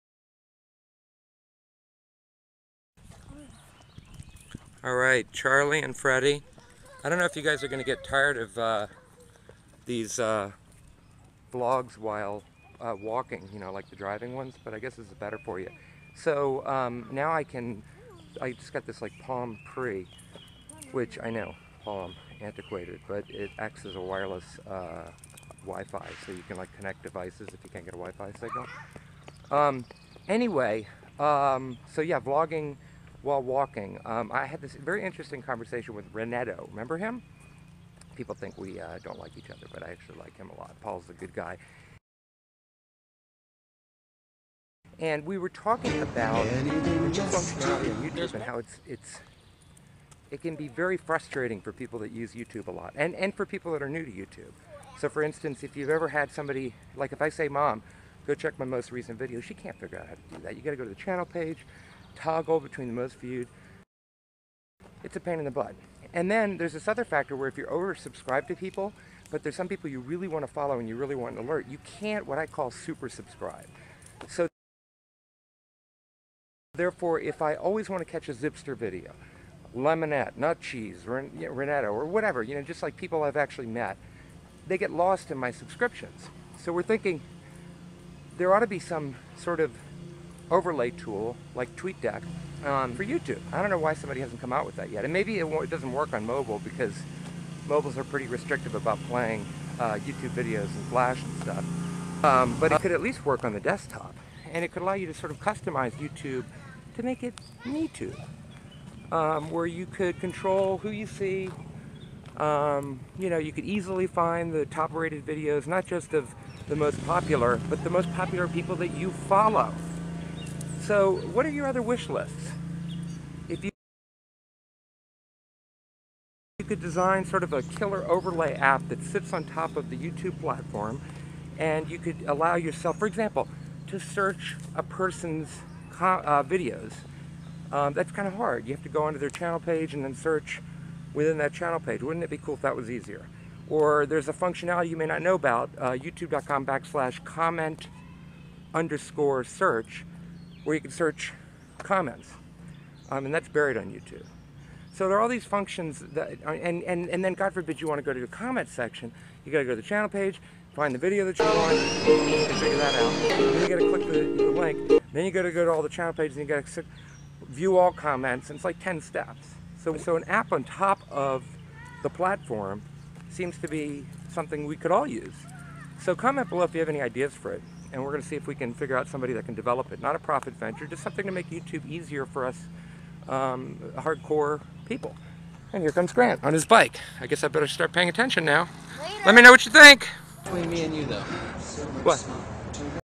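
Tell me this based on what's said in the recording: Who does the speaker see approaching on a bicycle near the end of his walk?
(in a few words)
Grant.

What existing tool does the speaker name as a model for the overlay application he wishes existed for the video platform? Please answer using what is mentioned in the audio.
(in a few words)
TweetDeck.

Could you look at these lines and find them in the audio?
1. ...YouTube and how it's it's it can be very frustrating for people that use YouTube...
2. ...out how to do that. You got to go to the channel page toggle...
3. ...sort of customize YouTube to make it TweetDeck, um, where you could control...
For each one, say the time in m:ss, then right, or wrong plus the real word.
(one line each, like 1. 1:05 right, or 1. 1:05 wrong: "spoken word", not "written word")
1. 0:48 right
2. 0:59 right
3. 1:45 wrong: "MeTube", not "TweetDeck".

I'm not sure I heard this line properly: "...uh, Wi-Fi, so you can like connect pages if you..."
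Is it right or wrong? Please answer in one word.
wrong.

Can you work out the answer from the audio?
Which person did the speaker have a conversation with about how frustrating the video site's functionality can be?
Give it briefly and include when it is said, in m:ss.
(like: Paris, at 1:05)
Renetto, at 0:36.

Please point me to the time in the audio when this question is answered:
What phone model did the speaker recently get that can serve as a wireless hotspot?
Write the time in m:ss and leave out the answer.
0:19.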